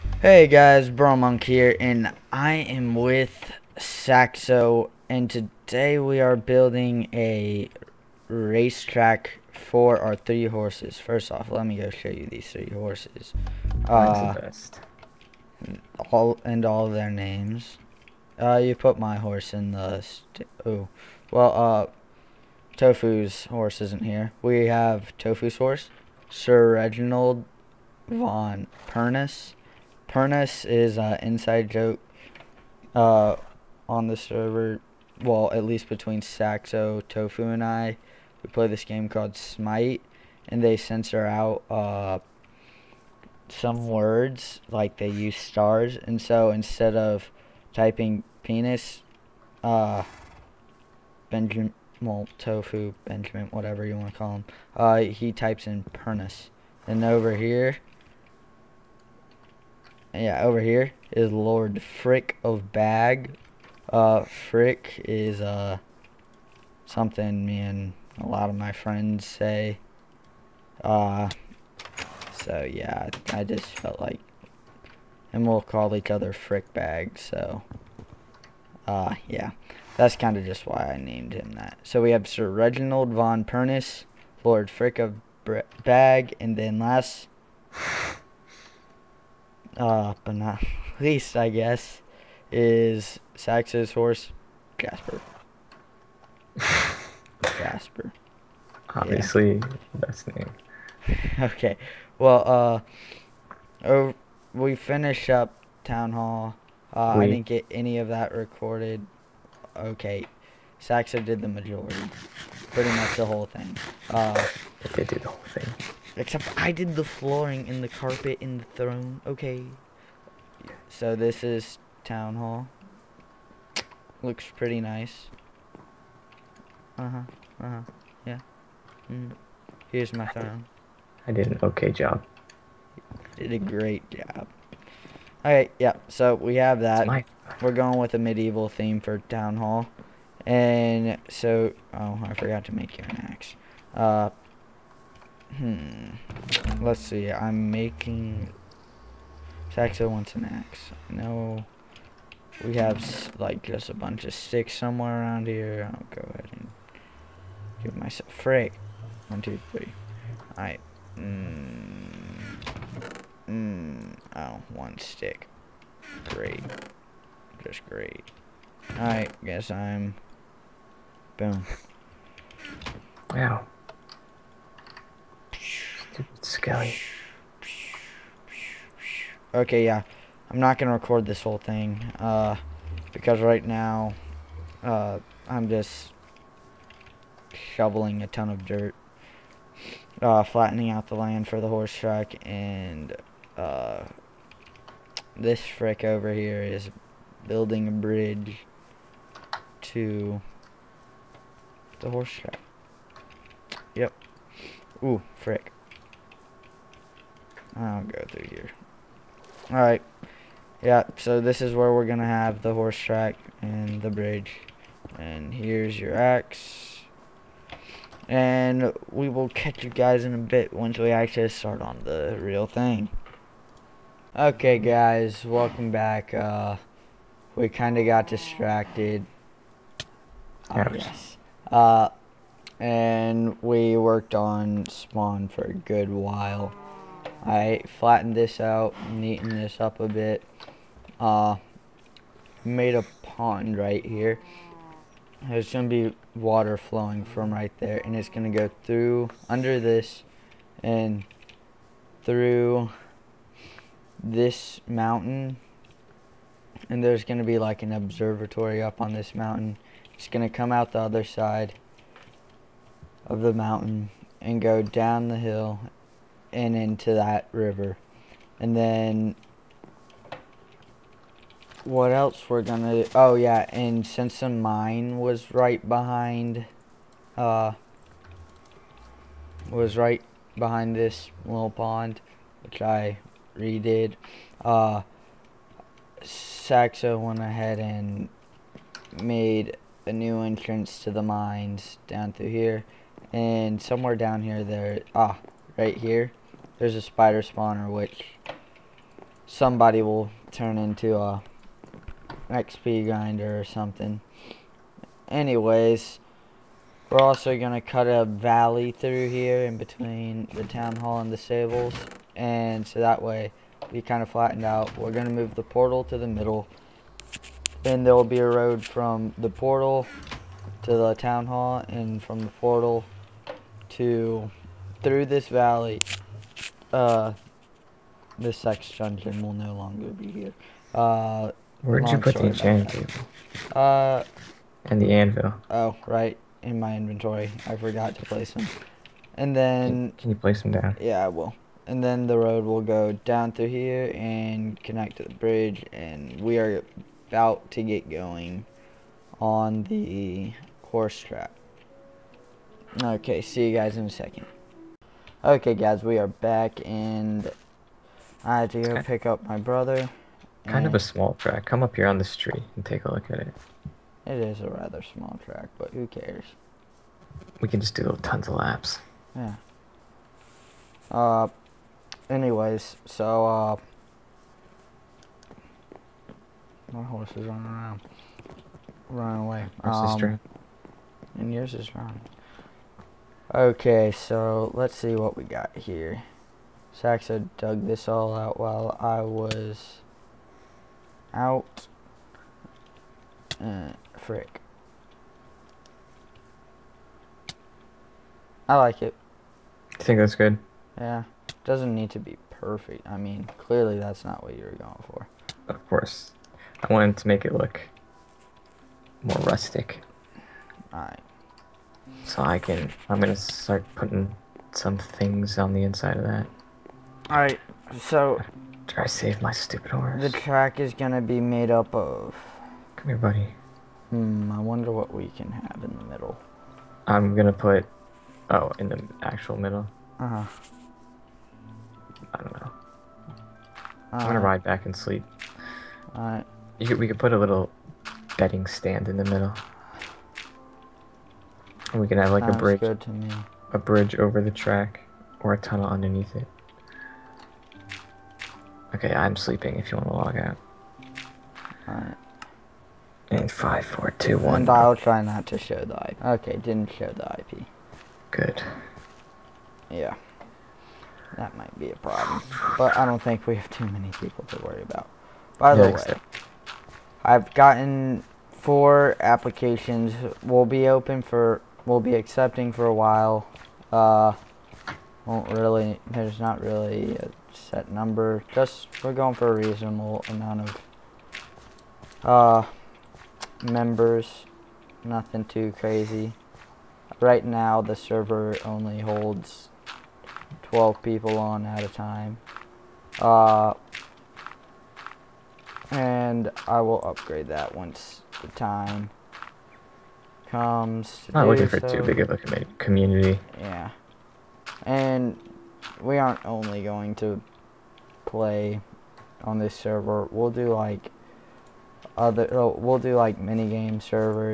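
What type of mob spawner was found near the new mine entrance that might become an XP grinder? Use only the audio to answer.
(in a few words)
spider spawner.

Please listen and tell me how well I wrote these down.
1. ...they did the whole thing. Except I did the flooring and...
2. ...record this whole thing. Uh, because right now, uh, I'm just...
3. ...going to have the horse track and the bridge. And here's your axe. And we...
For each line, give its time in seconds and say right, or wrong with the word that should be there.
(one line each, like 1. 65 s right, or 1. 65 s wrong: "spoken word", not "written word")
1. 114 s right
2. 180 s right
3. 212 s right.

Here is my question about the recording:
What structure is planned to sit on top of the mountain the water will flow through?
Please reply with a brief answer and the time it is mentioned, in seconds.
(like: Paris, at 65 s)
an observatory, at 257 s.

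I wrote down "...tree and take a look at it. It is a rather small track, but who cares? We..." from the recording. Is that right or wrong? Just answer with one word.
right.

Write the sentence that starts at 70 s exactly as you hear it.
Uh, so yeah, I just felt like, and we'll call each other Frick Bag.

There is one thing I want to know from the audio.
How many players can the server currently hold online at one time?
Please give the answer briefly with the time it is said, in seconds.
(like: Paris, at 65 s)
12, at 490 s.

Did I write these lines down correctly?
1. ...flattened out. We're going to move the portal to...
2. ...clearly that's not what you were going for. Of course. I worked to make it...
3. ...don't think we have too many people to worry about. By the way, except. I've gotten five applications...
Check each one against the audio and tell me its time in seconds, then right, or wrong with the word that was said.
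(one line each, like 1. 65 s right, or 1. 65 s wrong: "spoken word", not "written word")
1. 314 s right
2. 403 s wrong: "wanted", not "worked"
3. 463 s wrong: "four", not "five".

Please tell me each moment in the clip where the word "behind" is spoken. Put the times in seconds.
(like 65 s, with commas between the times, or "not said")
275 s, 280 s.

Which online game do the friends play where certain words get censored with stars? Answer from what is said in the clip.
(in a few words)
Smite.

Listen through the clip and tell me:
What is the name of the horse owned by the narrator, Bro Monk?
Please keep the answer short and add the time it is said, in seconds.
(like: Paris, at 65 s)
Lord Frick of Bag, at 61 s.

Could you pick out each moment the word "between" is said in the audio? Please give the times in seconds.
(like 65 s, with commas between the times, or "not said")
35 s, 309 s.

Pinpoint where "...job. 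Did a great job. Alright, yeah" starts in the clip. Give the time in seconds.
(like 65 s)
131 s.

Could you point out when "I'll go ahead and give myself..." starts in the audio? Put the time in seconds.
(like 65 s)
155 s.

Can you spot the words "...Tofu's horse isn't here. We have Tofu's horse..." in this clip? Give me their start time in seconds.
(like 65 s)
22 s.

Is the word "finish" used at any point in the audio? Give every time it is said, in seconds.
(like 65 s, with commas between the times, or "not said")
104 s.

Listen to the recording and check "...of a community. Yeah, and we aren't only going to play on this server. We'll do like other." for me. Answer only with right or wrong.
right.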